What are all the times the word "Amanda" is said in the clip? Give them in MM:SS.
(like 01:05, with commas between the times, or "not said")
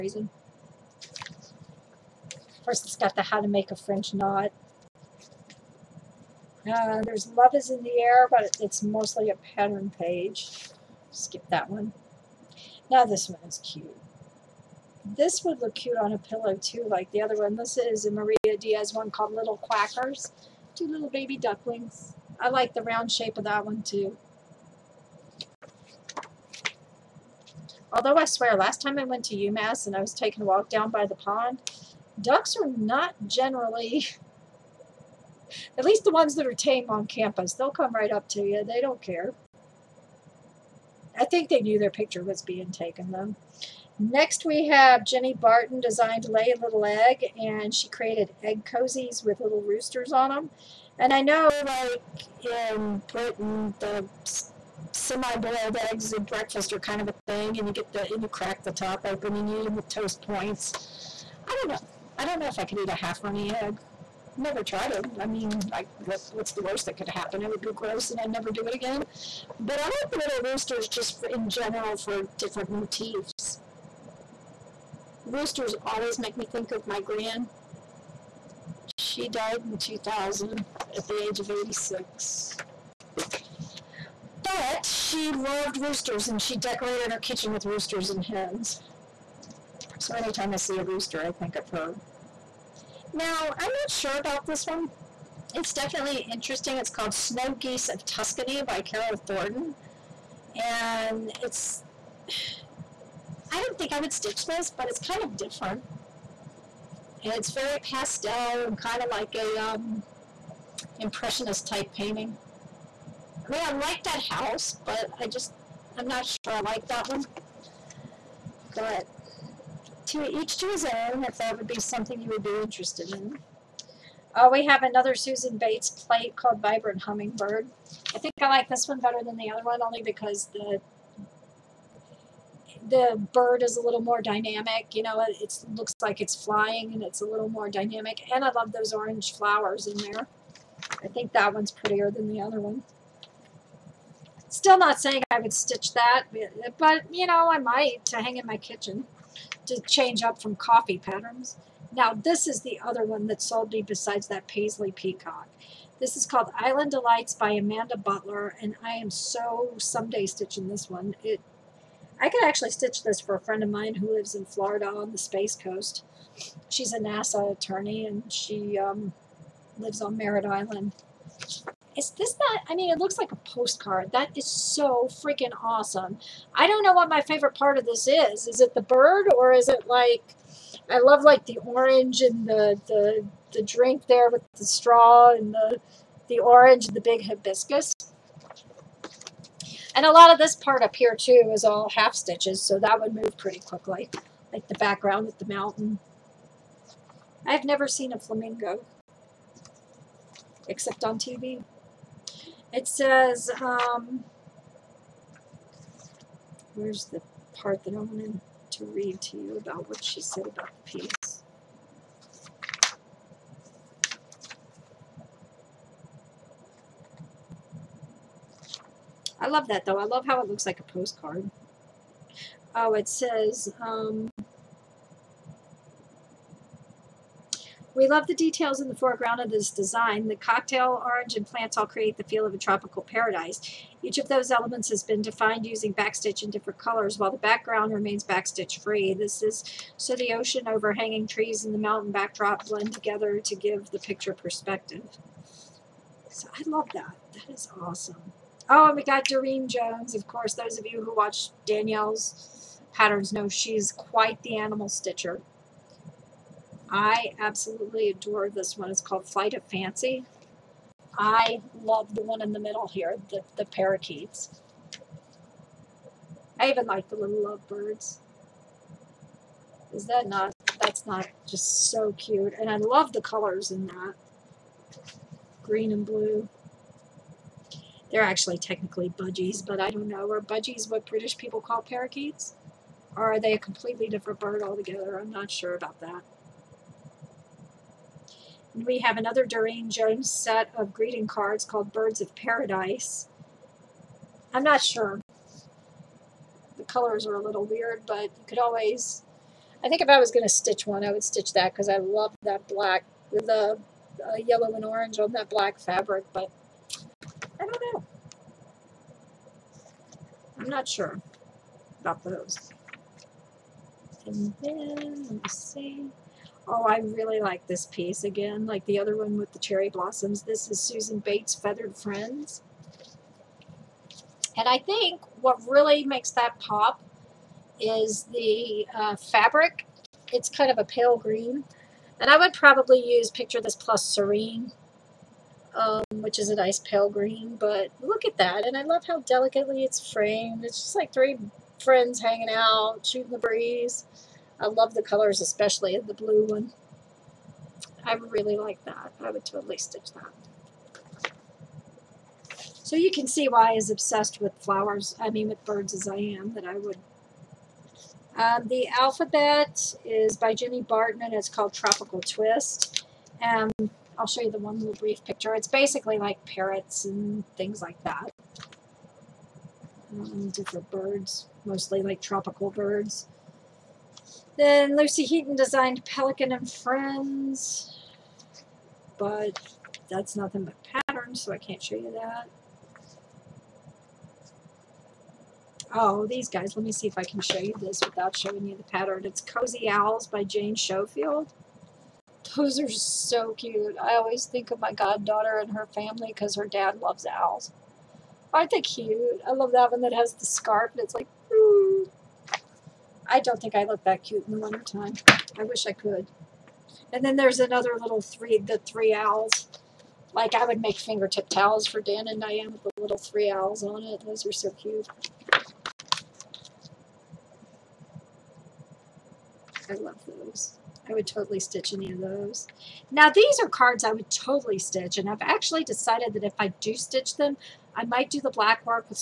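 02:37.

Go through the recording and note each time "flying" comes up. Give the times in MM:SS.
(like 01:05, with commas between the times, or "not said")
02:16.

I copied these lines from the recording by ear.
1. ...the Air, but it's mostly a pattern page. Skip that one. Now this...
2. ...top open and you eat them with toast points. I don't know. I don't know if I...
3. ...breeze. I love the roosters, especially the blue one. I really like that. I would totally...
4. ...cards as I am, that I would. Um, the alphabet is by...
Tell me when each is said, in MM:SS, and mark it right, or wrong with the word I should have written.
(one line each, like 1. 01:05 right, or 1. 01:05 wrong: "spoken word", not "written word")
1. 00:07 right
2. 00:58 right
3. 05:43 wrong: "colors", not "roosters"
4. 05:55 wrong: "birds", not "cards".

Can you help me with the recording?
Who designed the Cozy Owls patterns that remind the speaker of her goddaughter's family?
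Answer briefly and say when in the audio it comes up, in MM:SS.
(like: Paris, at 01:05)
Jane Schofield, at 06:30.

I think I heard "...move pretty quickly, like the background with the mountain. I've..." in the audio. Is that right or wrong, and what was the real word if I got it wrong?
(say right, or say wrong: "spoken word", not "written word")
right.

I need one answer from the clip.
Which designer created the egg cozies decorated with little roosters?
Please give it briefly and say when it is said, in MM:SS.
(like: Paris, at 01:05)
Jenny Barton, at 00:45.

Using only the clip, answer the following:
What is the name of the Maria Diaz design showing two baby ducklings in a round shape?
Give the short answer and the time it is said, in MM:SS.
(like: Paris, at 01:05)
Little Quackers, at 00:19.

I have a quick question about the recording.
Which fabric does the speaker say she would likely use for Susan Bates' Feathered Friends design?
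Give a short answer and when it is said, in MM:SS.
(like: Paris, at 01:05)
Picture This Plus Serene, at 05:33.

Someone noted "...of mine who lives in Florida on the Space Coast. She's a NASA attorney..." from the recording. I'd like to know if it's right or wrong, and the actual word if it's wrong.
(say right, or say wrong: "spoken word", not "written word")
right.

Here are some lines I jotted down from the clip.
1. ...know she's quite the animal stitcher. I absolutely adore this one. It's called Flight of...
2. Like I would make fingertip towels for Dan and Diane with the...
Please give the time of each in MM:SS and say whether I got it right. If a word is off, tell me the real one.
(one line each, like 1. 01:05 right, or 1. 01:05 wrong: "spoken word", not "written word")
1. 04:13 right
2. 06:50 right.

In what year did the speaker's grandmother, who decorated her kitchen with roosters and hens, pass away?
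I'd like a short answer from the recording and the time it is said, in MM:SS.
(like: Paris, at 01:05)
2000, at 01:19.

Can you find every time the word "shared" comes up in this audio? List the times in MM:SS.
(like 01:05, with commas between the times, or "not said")
not said.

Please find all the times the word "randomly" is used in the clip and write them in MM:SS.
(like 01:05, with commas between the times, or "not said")
not said.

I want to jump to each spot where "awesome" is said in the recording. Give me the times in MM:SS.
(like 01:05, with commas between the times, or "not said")
02:55, 04:07.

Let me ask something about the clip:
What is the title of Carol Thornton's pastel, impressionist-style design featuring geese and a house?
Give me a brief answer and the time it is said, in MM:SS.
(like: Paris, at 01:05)
Snow Geese of Tuscany, at 01:37.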